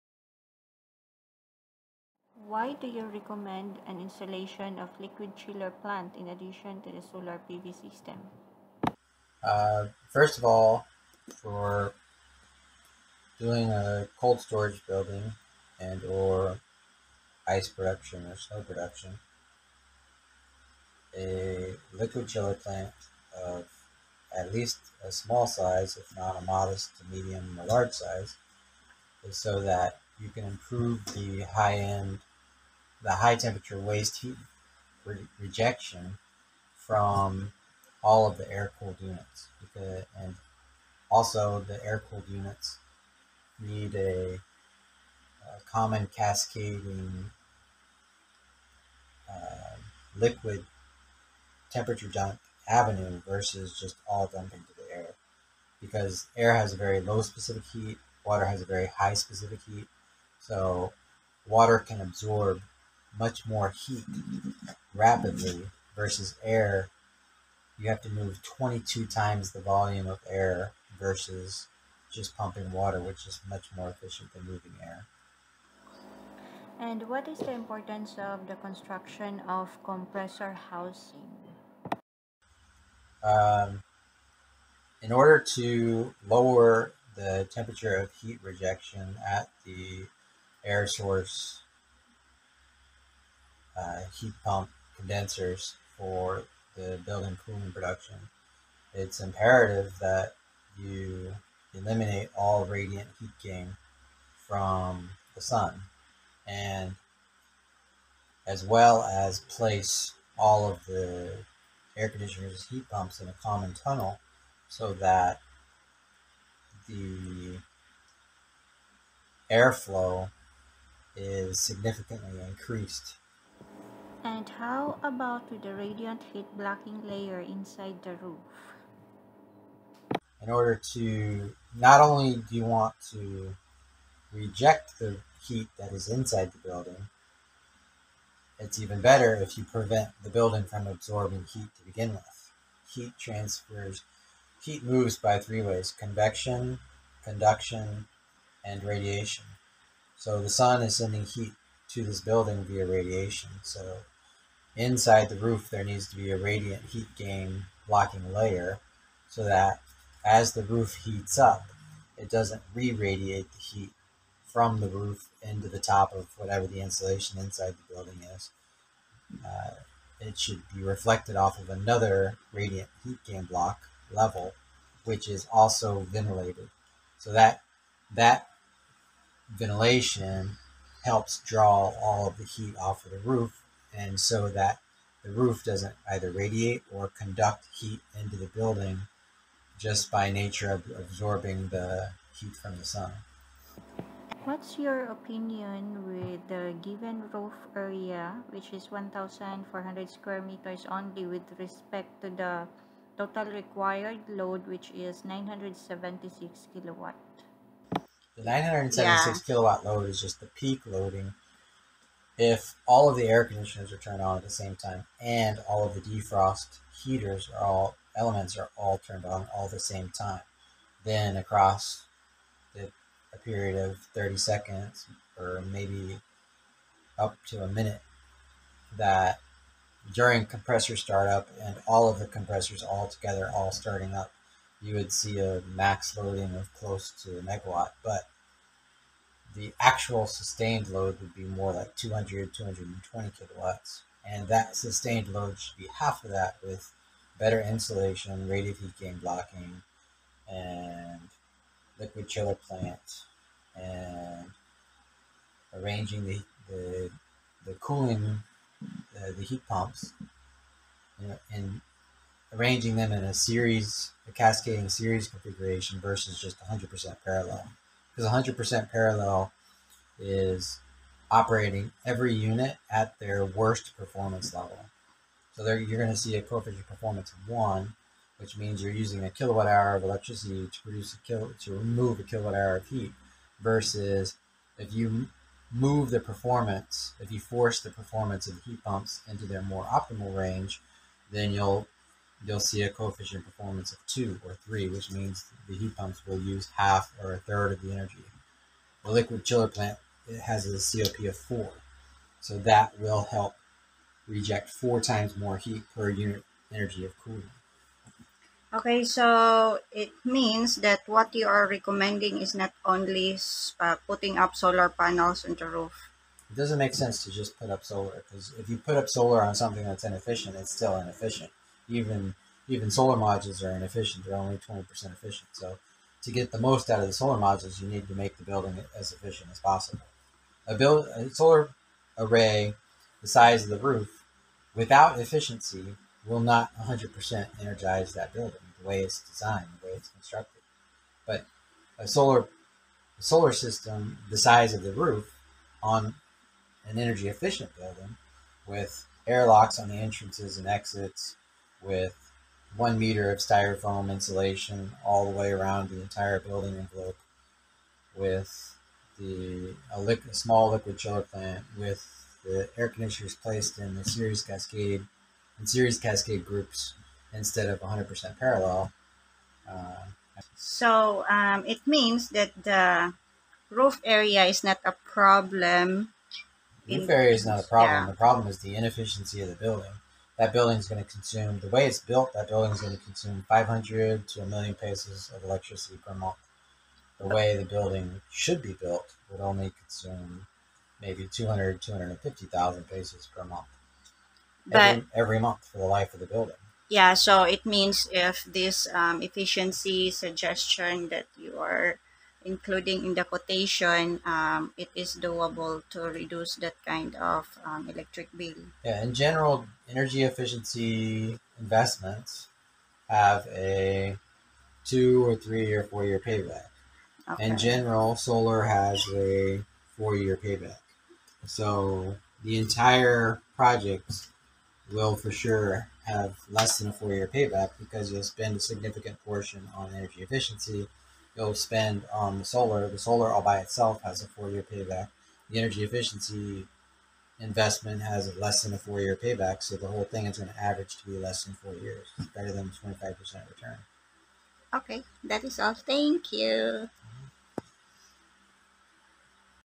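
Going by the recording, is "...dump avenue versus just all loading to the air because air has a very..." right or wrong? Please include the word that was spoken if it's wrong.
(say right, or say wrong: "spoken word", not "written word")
wrong: "dumping", not "loading".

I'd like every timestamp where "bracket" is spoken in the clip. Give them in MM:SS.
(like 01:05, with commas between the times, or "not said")
not said.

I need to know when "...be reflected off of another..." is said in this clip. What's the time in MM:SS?
02:50.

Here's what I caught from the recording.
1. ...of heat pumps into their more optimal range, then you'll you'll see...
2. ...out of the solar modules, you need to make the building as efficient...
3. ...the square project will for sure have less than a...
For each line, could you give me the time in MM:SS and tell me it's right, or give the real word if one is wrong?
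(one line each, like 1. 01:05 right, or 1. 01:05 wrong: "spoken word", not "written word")
1. 04:48 right
2. 05:26 right
3. 07:02 wrong: "entire", not "square".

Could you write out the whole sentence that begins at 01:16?
And what is the importance of the construction of compressor housing?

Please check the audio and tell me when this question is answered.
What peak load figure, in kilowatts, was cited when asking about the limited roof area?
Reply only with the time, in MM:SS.
03:25.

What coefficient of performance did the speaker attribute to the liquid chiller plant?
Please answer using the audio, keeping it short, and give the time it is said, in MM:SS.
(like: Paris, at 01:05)
4, at 05:01.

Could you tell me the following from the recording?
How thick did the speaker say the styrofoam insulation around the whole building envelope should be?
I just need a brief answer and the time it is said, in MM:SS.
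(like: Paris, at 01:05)
1 meter, at 05:52.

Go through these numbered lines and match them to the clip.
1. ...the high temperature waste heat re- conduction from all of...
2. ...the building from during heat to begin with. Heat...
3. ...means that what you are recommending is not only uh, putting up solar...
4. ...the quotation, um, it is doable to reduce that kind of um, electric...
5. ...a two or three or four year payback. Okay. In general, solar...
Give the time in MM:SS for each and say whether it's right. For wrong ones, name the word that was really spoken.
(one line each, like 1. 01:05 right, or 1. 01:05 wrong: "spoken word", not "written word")
1. 00:33 wrong: "rejection", not "conduction"
2. 02:20 wrong: "absorbing", not "during"
3. 05:10 right
4. 06:43 right
5. 06:53 right.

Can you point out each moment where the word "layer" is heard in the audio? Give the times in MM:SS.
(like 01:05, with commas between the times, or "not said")
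02:07, 02:38.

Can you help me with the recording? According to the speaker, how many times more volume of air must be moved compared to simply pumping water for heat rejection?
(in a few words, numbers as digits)
22 times.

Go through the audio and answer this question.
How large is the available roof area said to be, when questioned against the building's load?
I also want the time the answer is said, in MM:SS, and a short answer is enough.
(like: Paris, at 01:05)
1,400 square meters, at 03:18.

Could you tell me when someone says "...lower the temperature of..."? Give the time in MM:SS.
01:26.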